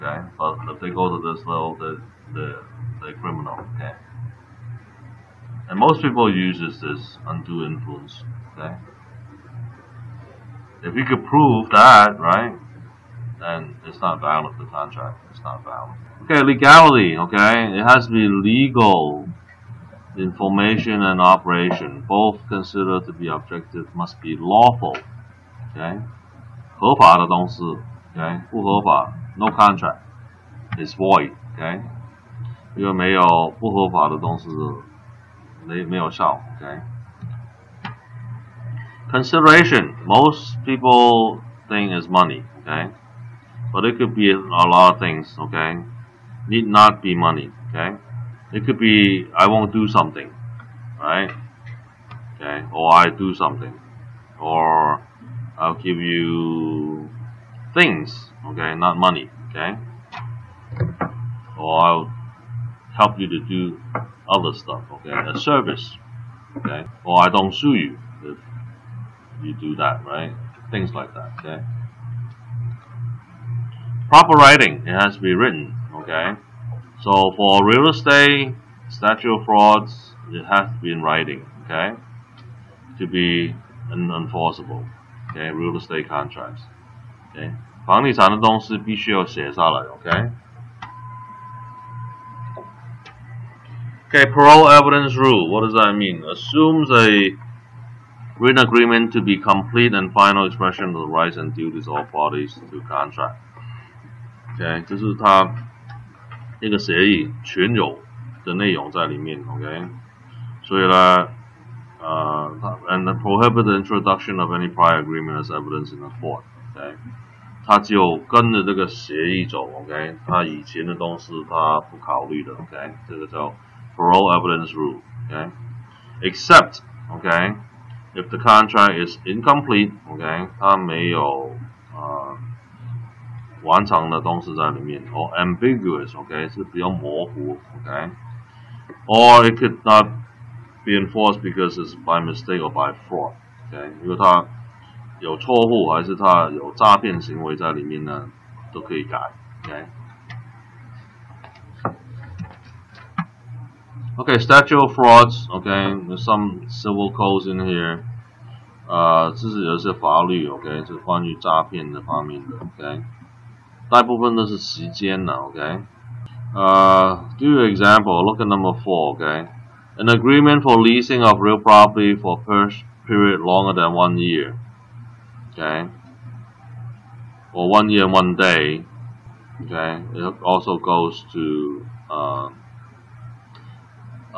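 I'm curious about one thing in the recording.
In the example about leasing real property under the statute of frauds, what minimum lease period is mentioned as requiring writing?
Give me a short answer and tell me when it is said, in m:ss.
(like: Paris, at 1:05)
Longer than one year, at 2:53.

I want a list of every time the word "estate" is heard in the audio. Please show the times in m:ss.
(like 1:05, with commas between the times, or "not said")
1:17, 1:25.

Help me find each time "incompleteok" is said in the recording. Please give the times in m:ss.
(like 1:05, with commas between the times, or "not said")
2:09.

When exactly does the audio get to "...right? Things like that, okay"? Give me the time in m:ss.
1:10.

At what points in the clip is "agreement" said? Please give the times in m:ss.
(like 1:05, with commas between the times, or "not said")
1:38, 1:54, 2:50.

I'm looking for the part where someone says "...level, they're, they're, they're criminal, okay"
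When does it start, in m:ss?
0:01.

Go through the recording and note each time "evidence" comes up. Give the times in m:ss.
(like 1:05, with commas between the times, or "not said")
1:34, 1:55.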